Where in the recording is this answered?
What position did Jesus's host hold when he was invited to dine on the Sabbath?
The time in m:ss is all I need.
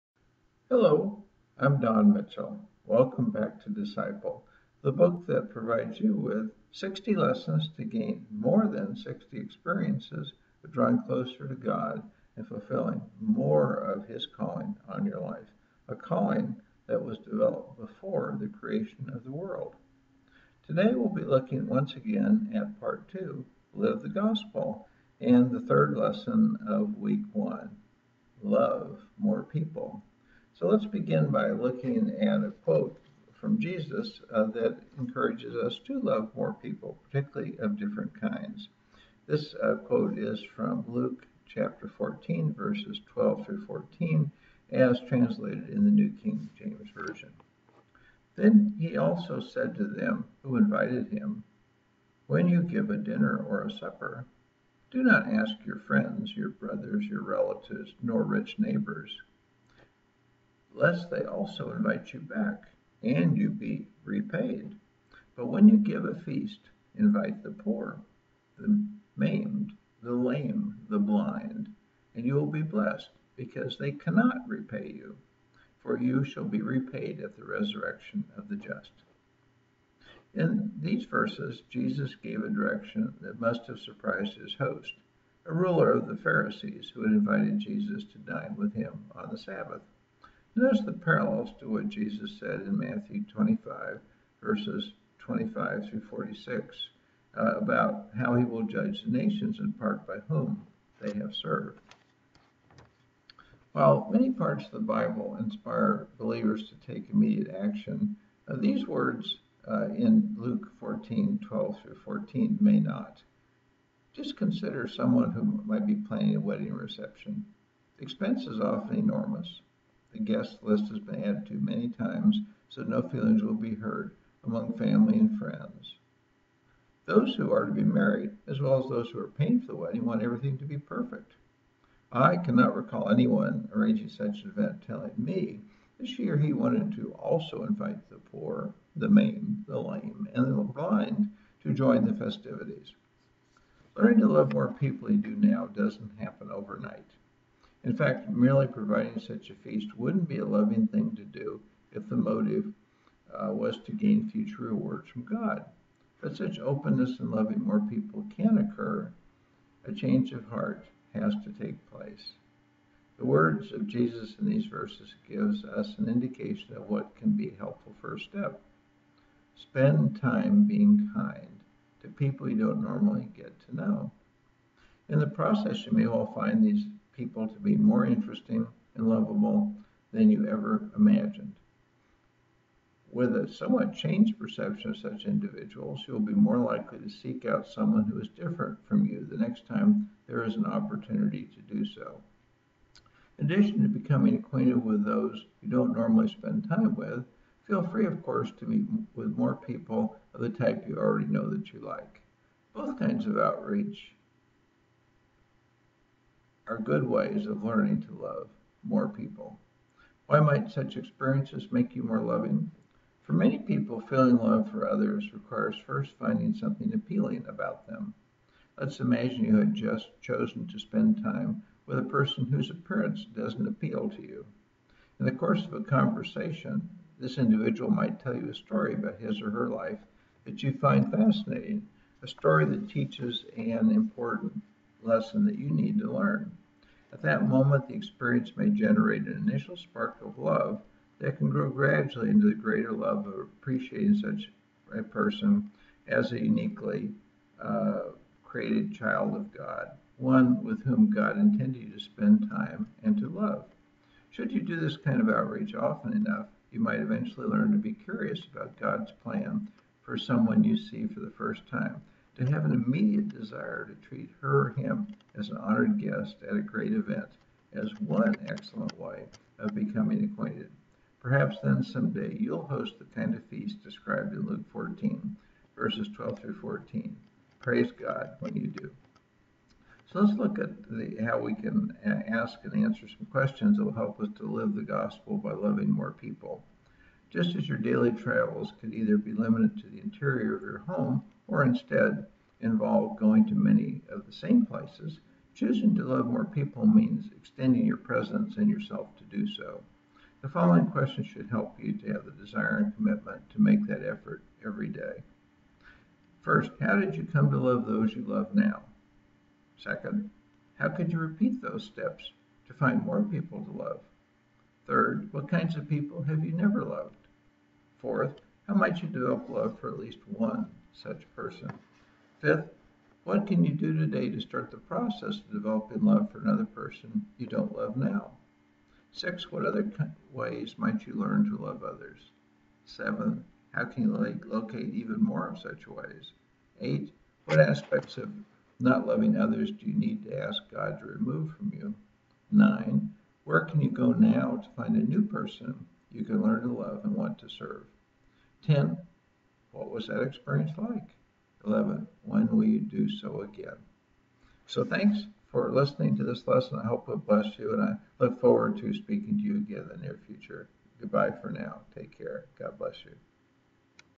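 1:25.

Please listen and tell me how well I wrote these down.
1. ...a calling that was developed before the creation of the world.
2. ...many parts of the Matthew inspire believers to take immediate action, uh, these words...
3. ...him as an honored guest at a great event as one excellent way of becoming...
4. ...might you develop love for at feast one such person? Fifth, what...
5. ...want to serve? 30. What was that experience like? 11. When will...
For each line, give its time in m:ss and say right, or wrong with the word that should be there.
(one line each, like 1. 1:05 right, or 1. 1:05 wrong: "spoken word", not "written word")
1. 0:15 right
2. 1:44 wrong: "Bible", not "Matthew"
3. 4:24 right
4. 5:18 wrong: "least", not "feast"
5. 5:47 wrong: "10", not "30".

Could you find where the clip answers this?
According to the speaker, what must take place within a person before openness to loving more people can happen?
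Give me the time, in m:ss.
2:39.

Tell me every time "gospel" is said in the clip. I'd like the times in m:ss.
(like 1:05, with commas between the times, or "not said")
0:24, 4:44.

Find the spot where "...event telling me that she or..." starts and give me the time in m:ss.
2:14.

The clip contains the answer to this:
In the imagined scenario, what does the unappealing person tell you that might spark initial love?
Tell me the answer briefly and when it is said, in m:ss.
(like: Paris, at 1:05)
a story about his or her life, at 3:48.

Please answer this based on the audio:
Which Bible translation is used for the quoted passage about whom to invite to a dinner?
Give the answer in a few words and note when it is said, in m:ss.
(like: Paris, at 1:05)
New King James Version, at 0:45.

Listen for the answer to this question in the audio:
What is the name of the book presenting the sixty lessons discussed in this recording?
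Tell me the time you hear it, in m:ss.
0:03.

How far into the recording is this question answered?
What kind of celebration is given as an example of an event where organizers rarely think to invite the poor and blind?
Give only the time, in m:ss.
1:56.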